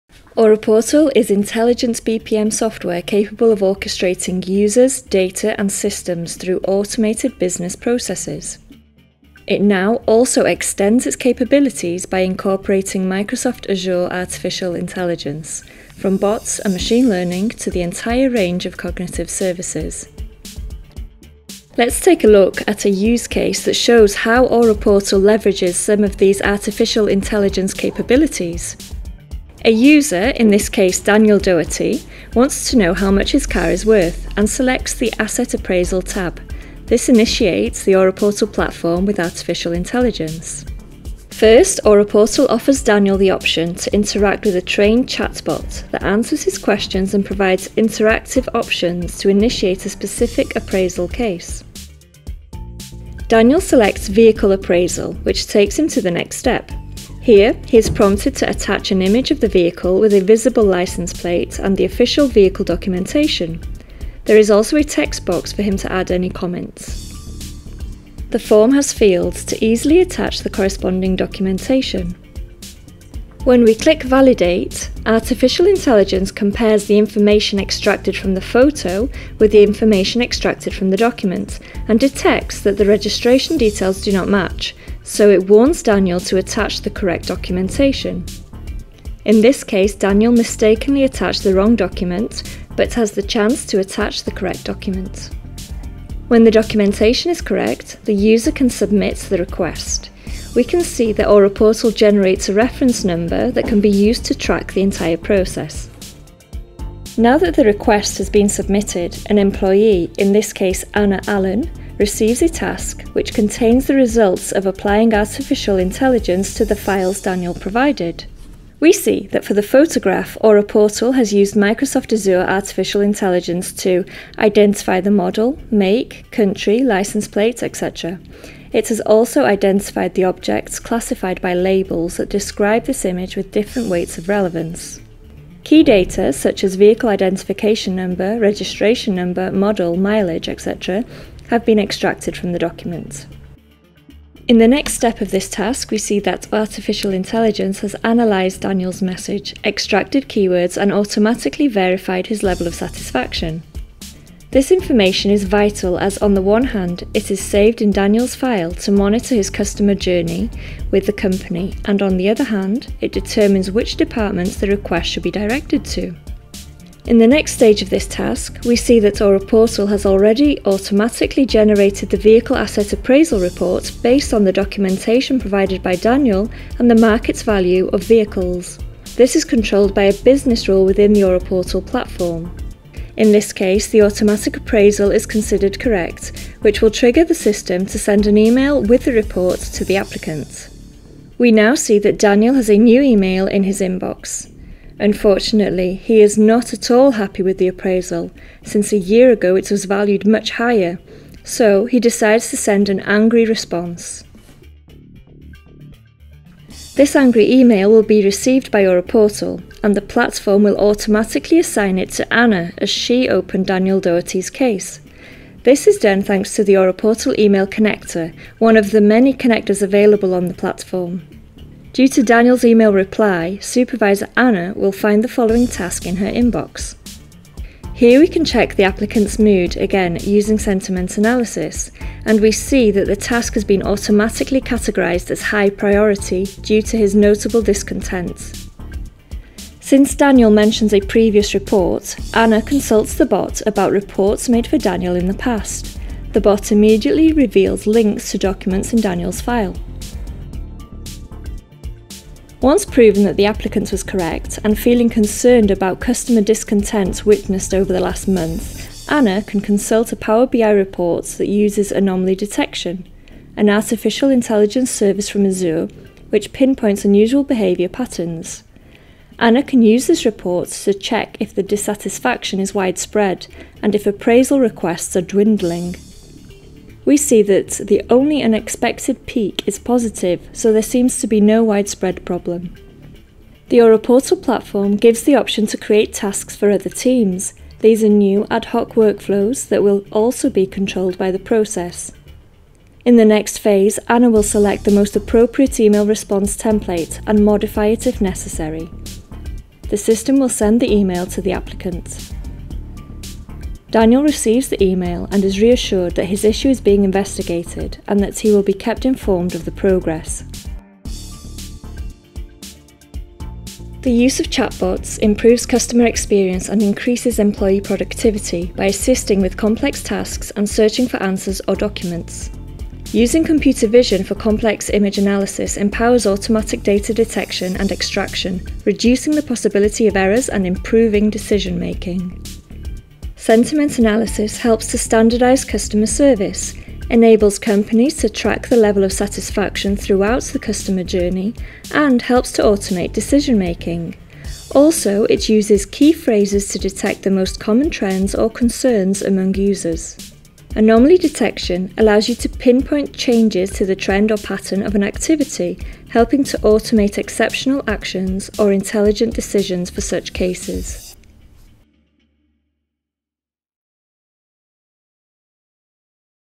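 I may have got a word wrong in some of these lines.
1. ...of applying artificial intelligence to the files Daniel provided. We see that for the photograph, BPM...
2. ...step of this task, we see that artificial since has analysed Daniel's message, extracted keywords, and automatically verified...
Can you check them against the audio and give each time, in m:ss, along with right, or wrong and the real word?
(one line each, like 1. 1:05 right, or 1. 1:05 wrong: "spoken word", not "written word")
1. 1:54 wrong: "Aura", not "BPM"
2. 2:24 wrong: "intelligence", not "since".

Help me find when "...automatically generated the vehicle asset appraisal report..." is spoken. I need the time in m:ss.
2:50.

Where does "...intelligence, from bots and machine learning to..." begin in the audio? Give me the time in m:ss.
0:14.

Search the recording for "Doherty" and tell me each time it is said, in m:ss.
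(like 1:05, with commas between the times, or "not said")
0:31, 3:34.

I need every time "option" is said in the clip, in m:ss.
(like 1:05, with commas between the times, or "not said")
0:43, 0:48, 4:45.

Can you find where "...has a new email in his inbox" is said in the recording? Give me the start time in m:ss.
3:12.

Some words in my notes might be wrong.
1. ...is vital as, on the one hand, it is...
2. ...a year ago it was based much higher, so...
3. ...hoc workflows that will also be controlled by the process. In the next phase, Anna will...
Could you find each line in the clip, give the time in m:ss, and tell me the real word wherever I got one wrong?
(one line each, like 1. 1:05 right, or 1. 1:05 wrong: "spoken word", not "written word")
1. 2:35 right
2. 3:18 wrong: "valued", not "based"
3. 4:48 right.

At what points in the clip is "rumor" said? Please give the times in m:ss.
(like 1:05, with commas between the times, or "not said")
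not said.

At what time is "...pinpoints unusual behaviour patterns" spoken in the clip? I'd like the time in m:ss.
4:26.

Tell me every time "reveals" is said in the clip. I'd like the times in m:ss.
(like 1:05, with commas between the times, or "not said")
4:07.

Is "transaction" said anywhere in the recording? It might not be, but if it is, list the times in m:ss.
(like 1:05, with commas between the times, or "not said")
not said.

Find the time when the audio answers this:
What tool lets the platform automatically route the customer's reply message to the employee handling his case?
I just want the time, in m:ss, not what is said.
3:37.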